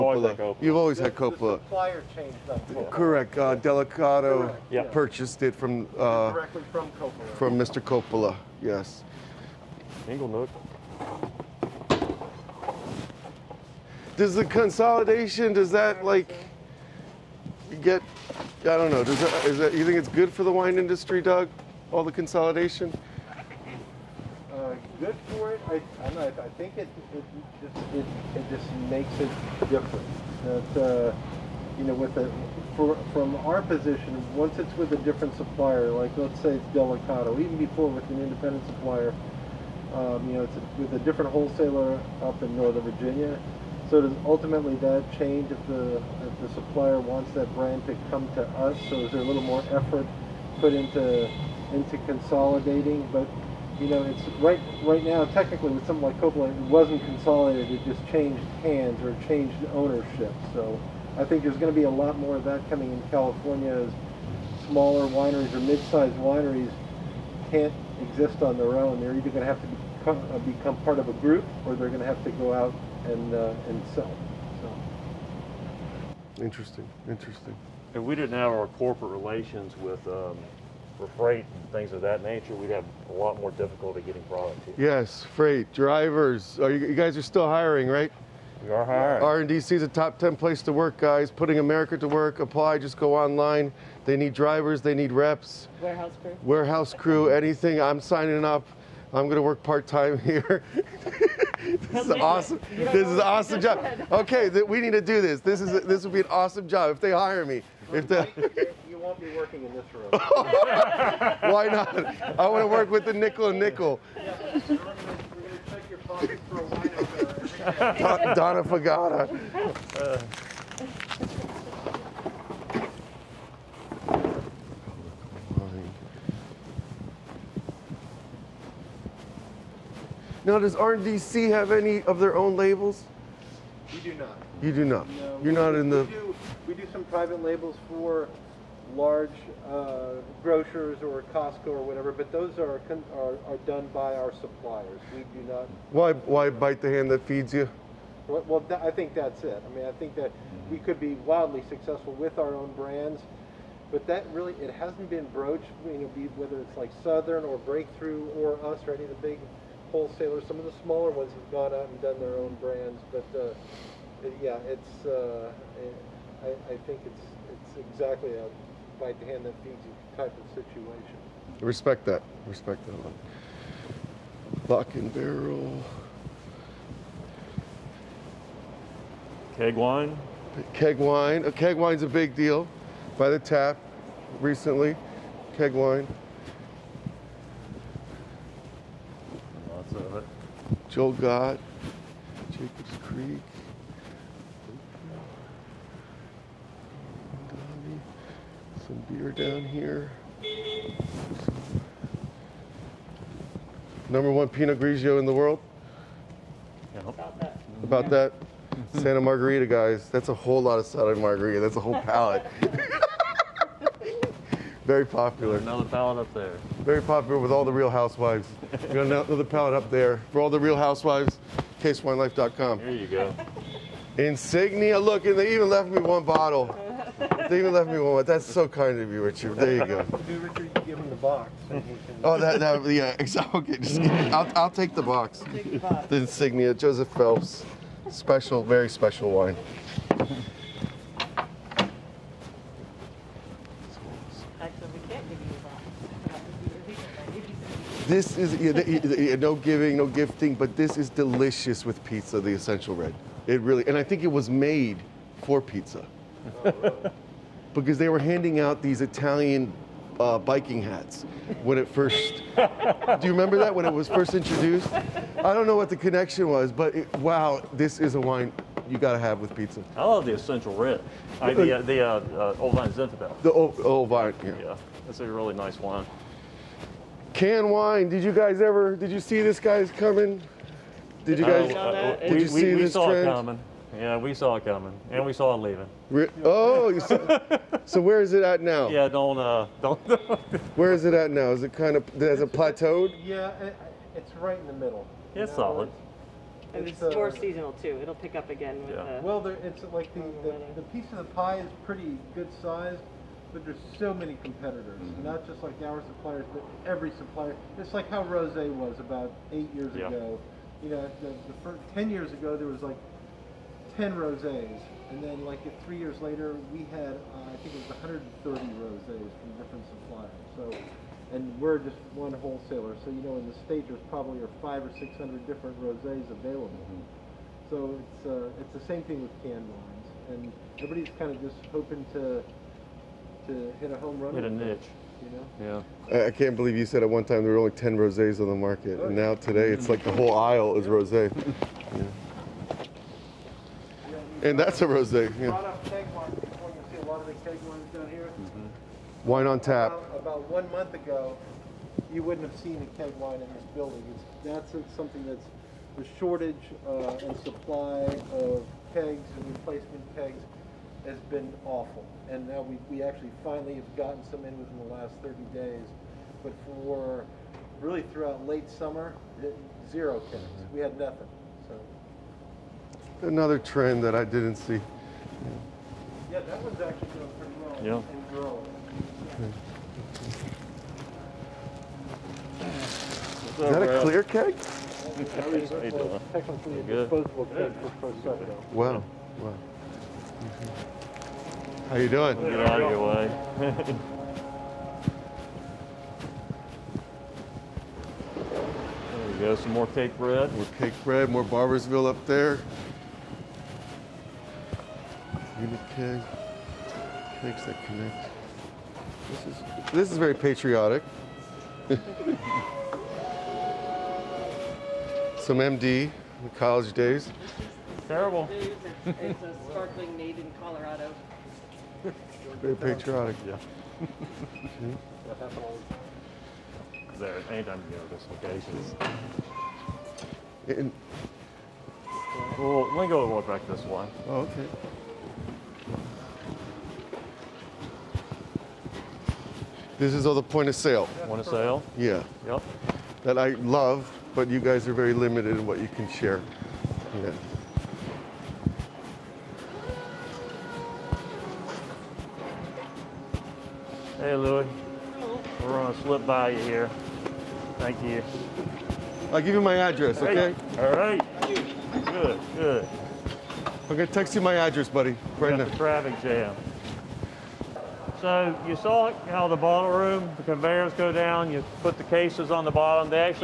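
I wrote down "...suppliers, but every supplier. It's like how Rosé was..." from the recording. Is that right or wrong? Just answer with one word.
right.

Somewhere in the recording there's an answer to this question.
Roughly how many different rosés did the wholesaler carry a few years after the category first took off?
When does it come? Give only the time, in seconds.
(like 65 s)
318 s.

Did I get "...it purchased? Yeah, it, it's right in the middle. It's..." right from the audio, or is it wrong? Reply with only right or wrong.
wrong.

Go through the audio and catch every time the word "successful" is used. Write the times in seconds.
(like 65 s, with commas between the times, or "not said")
151 s.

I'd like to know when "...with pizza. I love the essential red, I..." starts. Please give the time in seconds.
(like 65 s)
269 s.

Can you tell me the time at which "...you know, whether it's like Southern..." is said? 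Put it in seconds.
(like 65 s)
155 s.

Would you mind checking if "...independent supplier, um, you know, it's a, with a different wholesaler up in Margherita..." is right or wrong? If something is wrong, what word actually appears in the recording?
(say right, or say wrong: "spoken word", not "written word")
wrong: "Northern", not "Margherita".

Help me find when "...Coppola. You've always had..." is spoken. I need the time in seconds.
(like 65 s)
0 s.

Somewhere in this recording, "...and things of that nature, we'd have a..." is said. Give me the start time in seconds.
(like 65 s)
81 s.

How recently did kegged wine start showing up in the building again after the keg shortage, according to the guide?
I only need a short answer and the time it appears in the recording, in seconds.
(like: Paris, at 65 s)
About one month ago, at 350 s.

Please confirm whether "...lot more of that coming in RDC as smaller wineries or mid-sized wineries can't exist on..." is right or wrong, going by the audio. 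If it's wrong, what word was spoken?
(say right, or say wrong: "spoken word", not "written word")
wrong: "California", not "RDC".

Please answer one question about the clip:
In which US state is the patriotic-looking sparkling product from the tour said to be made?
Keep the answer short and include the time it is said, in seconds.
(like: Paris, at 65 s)
Colorado, at 420 s.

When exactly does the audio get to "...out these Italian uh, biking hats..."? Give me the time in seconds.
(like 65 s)
258 s.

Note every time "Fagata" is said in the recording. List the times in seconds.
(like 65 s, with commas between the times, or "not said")
118 s.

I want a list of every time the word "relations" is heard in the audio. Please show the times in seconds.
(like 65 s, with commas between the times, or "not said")
79 s.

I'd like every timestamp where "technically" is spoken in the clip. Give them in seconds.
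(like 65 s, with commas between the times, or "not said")
55 s, 385 s.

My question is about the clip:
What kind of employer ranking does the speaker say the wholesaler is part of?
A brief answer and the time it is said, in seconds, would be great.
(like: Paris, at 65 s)
Top 10 place to work, at 89 s.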